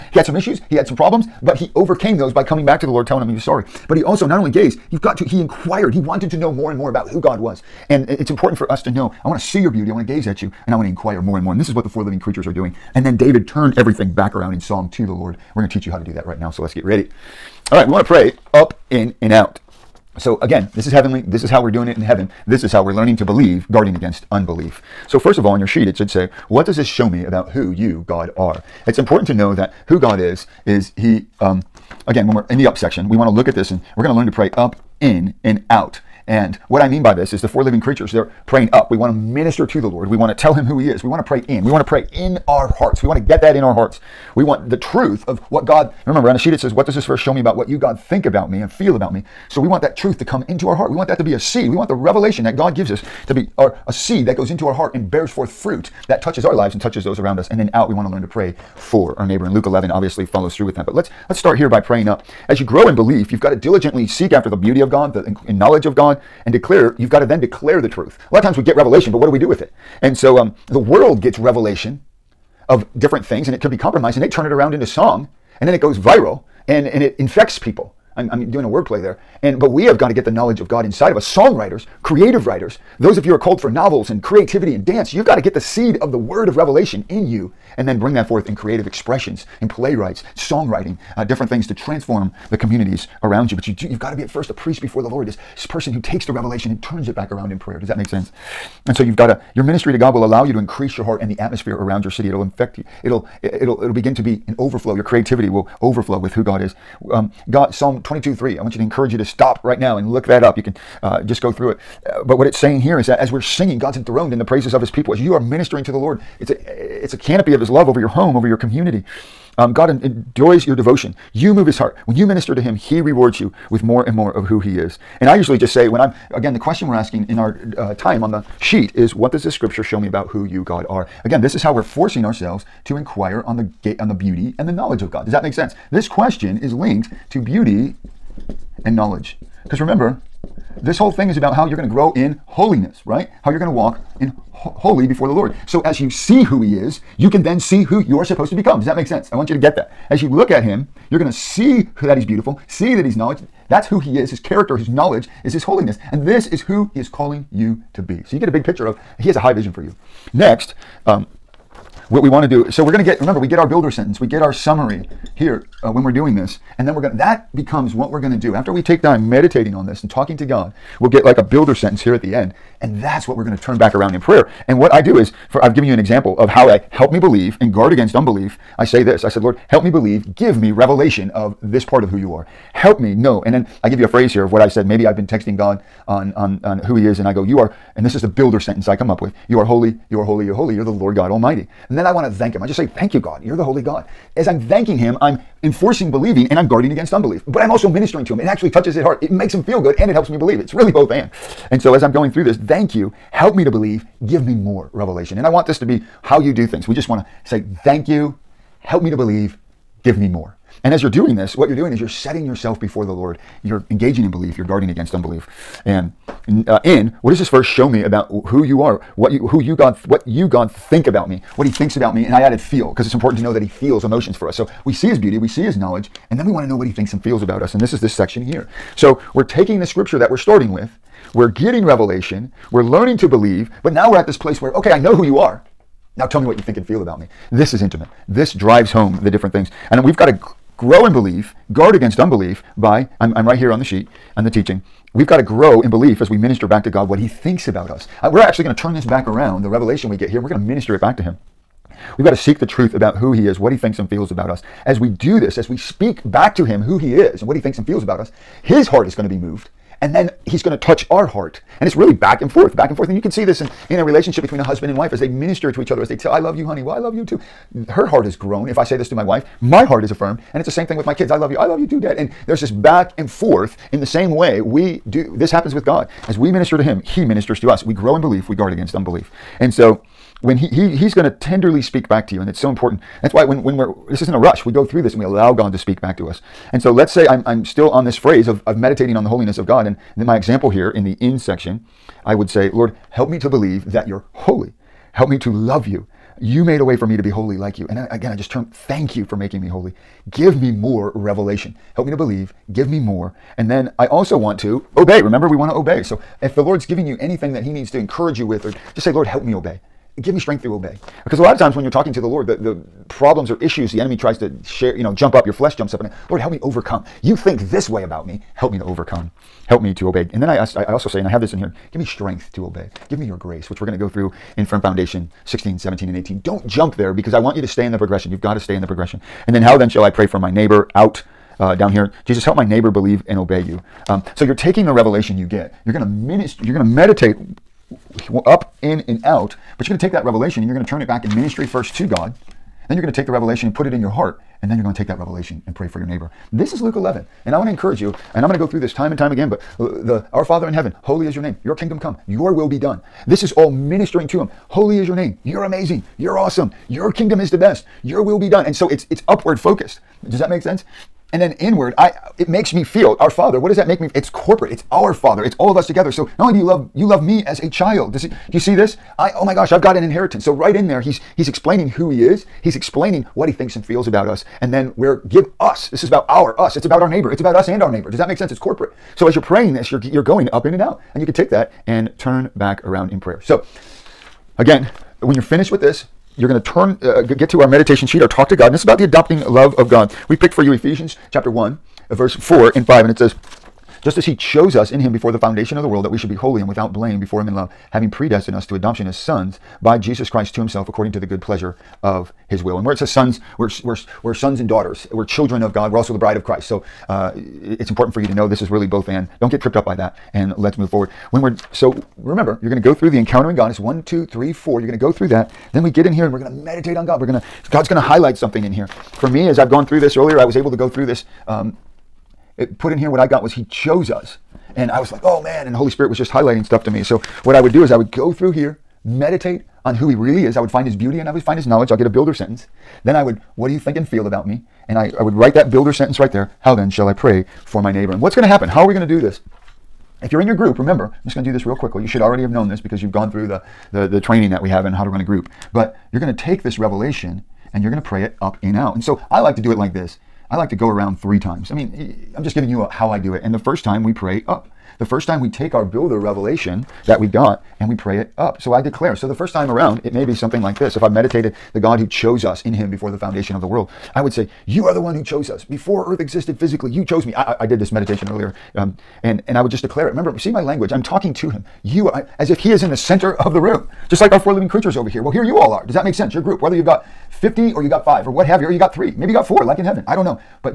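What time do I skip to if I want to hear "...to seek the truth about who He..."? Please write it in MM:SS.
04:12.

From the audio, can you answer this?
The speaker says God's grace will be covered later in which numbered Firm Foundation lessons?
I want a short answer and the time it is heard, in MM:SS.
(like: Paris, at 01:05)
16, 17, and 18, at 05:25.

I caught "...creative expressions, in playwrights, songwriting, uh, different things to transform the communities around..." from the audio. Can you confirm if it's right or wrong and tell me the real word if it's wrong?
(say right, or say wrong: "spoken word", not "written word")
right.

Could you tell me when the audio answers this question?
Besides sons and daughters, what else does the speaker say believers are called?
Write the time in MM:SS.
06:46.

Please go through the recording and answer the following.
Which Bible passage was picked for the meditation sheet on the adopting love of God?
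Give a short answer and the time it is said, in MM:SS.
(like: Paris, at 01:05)
Ephesians 1:4-5, at 06:30.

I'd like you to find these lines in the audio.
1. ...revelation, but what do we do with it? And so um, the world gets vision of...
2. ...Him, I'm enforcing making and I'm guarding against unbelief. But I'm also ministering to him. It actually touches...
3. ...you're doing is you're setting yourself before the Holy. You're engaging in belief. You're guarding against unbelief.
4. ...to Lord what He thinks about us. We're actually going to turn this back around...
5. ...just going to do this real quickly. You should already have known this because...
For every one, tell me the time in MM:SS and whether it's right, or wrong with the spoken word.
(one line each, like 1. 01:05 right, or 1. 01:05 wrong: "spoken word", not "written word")
1. 01:08 wrong: "revelation", not "vision"
2. 03:14 wrong: "believing", not "making"
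3. 03:31 wrong: "Lord", not "Holy"
4. 04:06 wrong: "God", not "Lord"
5. 07:21 right.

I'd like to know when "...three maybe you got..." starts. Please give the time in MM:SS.
07:58.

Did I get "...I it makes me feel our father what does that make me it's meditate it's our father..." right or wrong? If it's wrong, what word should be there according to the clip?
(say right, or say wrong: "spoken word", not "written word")
wrong: "corporate", not "meditate".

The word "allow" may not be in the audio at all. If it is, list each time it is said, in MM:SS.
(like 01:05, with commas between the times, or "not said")
01:40, 04:45.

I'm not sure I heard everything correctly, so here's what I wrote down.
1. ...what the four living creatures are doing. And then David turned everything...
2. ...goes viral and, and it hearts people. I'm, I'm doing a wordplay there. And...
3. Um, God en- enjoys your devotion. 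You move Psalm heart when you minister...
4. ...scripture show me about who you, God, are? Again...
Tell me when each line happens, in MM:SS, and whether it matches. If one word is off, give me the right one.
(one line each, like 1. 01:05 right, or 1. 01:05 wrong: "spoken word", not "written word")
1. 00:11 right
2. 01:15 wrong: "infects", not "hearts"
3. 01:59 wrong: "His", not "Psalm"
4. 02:09 right.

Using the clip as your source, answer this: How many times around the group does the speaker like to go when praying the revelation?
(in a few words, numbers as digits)
3.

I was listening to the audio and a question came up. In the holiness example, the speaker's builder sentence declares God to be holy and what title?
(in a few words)
Lord God Almighty.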